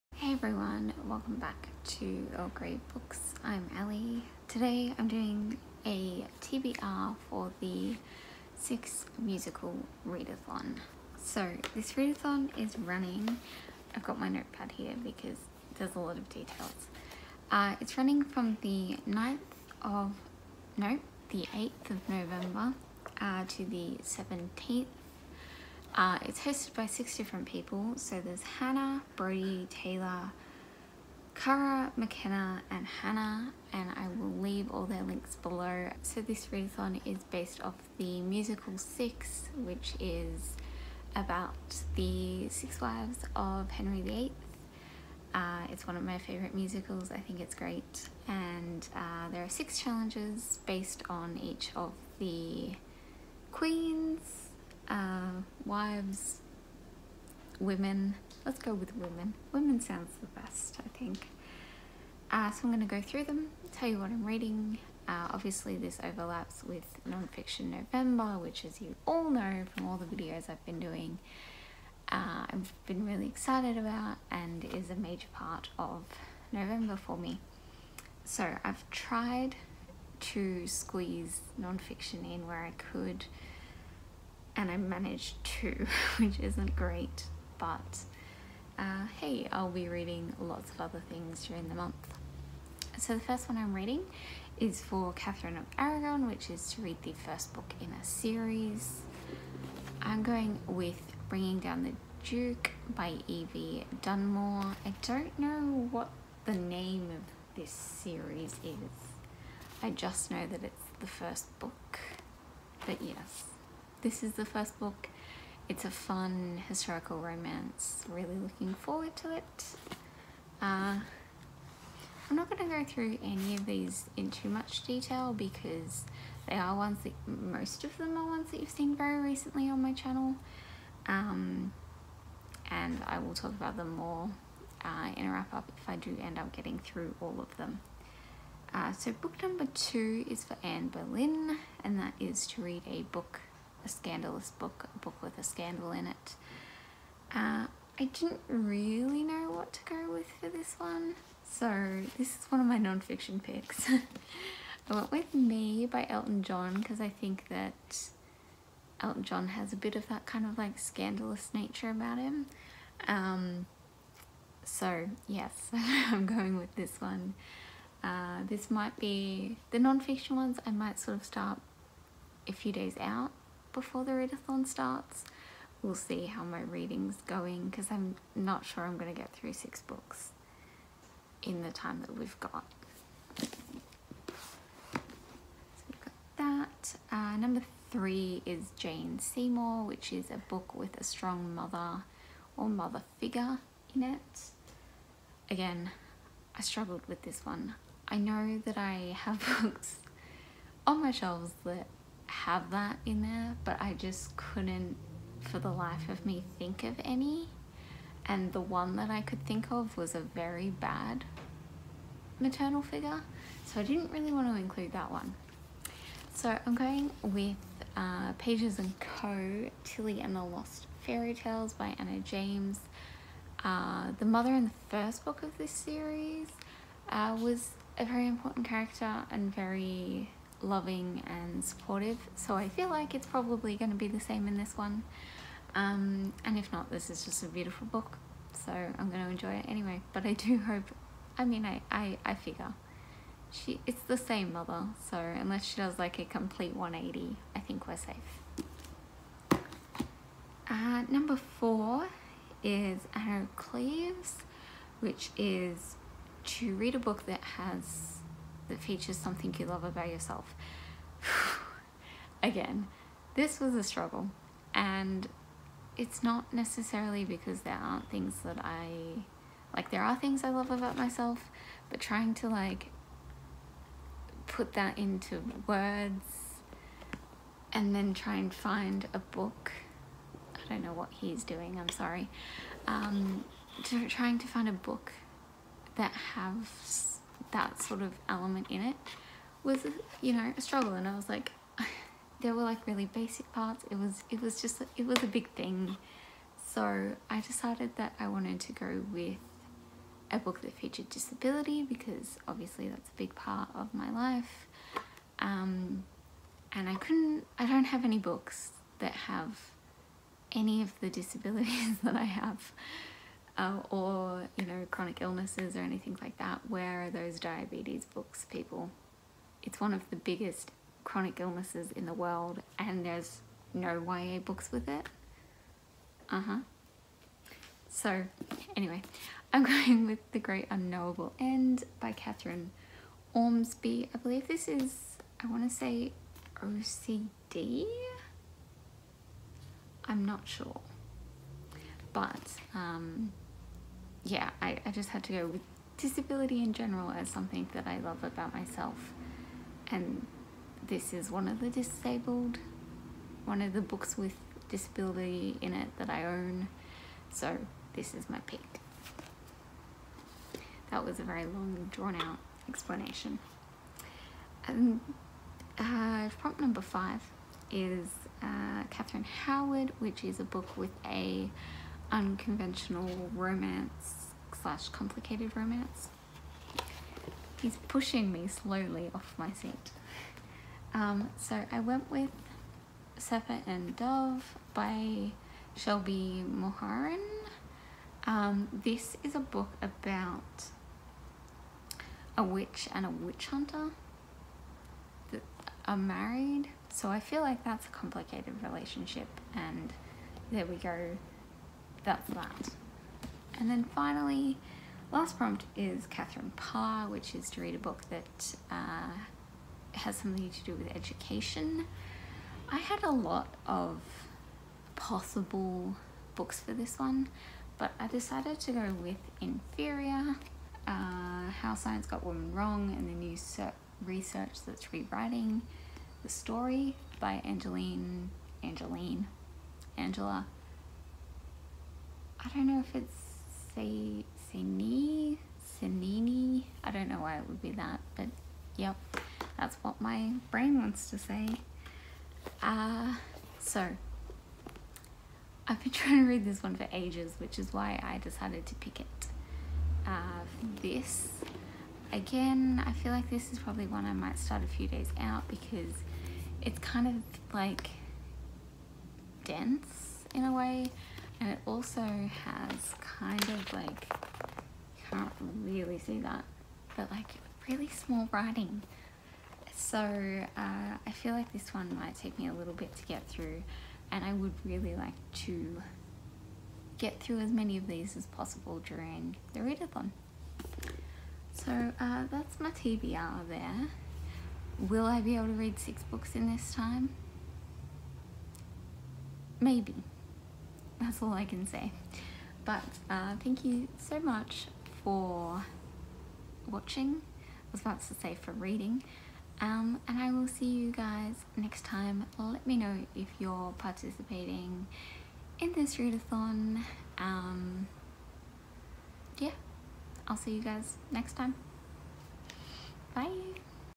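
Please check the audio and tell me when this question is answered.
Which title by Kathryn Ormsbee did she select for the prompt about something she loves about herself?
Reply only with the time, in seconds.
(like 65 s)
330 s.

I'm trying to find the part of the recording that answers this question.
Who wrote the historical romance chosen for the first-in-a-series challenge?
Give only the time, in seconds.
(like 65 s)
103 s.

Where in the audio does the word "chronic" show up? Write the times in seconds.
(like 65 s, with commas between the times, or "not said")
314 s, 321 s.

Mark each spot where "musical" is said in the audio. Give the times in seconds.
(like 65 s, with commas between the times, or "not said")
9 s, 38 s, 46 s.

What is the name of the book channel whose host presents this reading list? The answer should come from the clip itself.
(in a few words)
Earl Grey Books.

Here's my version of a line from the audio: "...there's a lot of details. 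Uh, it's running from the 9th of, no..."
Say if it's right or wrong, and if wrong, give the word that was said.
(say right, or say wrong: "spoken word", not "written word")
right.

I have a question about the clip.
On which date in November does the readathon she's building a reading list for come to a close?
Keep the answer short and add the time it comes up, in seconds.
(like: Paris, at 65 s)
17th, at 24 s.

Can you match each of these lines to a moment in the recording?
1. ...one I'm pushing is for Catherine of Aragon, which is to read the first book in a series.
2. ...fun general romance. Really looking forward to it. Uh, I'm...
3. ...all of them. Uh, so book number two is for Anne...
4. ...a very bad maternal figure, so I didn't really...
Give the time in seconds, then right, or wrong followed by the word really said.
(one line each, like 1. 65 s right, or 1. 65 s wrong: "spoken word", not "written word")
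1. 93 s wrong: "reading", not "pushing"
2. 115 s wrong: "historical", not "general"
3. 137 s right
4. 210 s right.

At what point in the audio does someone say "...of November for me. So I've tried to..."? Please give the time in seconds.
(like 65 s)
75 s.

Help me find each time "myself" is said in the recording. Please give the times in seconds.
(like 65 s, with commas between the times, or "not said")
270 s, 348 s.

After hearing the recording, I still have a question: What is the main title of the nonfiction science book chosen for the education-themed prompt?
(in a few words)
Inferior.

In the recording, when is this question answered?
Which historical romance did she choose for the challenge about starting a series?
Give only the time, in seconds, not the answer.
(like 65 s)
101 s.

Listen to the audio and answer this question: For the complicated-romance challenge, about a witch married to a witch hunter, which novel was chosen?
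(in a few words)
Serpent and Dove.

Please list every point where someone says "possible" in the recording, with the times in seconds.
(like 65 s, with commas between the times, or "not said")
414 s, 478 s.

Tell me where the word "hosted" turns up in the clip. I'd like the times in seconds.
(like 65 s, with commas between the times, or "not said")
26 s.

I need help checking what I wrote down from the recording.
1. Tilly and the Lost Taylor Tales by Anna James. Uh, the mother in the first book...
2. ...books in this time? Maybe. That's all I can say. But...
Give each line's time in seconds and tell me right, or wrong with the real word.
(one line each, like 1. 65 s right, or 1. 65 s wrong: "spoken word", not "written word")
1. 219 s wrong: "Fairy", not "Taylor"
2. 486 s right.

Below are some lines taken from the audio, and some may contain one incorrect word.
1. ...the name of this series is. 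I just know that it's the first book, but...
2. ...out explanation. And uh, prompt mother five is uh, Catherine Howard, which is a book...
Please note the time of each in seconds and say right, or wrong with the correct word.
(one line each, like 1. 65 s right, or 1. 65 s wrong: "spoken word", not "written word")
1. 106 s right
2. 362 s wrong: "number", not "mother".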